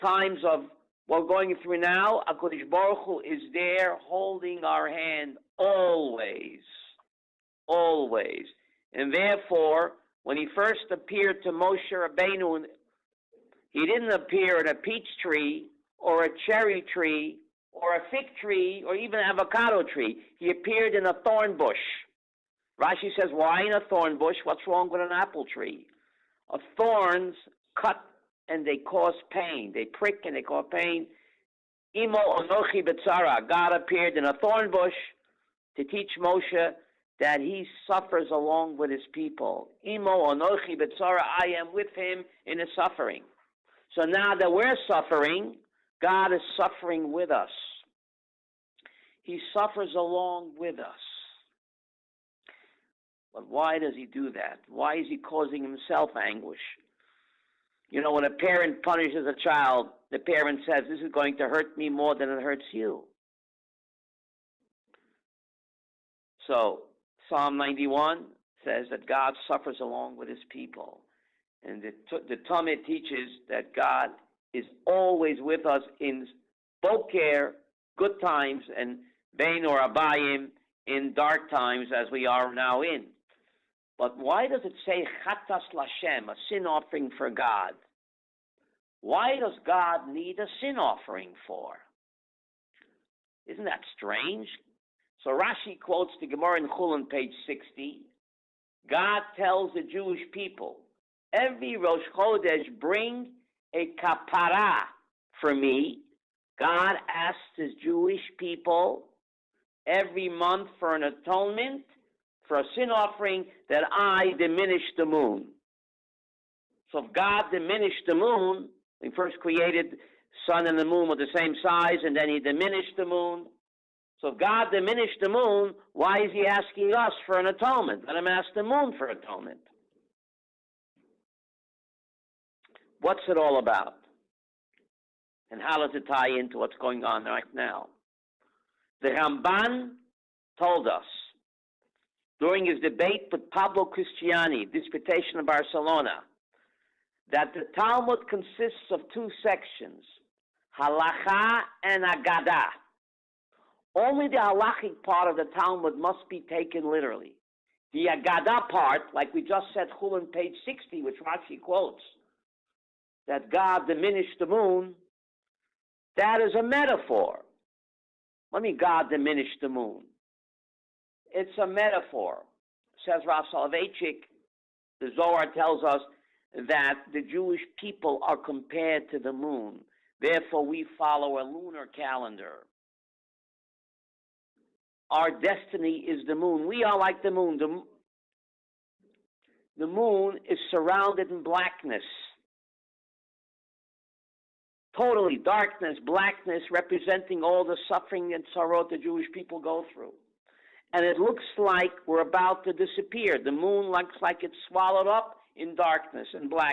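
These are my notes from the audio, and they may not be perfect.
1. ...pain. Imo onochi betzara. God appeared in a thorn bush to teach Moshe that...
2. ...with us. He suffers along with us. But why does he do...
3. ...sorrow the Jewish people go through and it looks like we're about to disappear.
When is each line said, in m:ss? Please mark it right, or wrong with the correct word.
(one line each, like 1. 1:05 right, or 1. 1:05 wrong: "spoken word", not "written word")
1. 0:30 right
2. 0:47 right
3. 3:18 right.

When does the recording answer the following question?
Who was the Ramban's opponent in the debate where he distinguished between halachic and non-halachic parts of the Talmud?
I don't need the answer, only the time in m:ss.
2:23.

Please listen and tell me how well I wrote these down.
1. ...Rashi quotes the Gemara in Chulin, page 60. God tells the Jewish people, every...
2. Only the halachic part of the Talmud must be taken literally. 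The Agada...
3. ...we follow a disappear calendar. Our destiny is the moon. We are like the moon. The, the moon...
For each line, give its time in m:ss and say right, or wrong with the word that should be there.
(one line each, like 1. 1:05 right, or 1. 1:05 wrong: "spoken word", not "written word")
1. 1:35 right
2. 2:33 right
3. 3:00 wrong: "lunar", not "disappear".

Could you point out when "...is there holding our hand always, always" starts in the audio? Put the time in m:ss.
0:03.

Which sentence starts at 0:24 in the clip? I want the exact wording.
What's wrong with an apple tree?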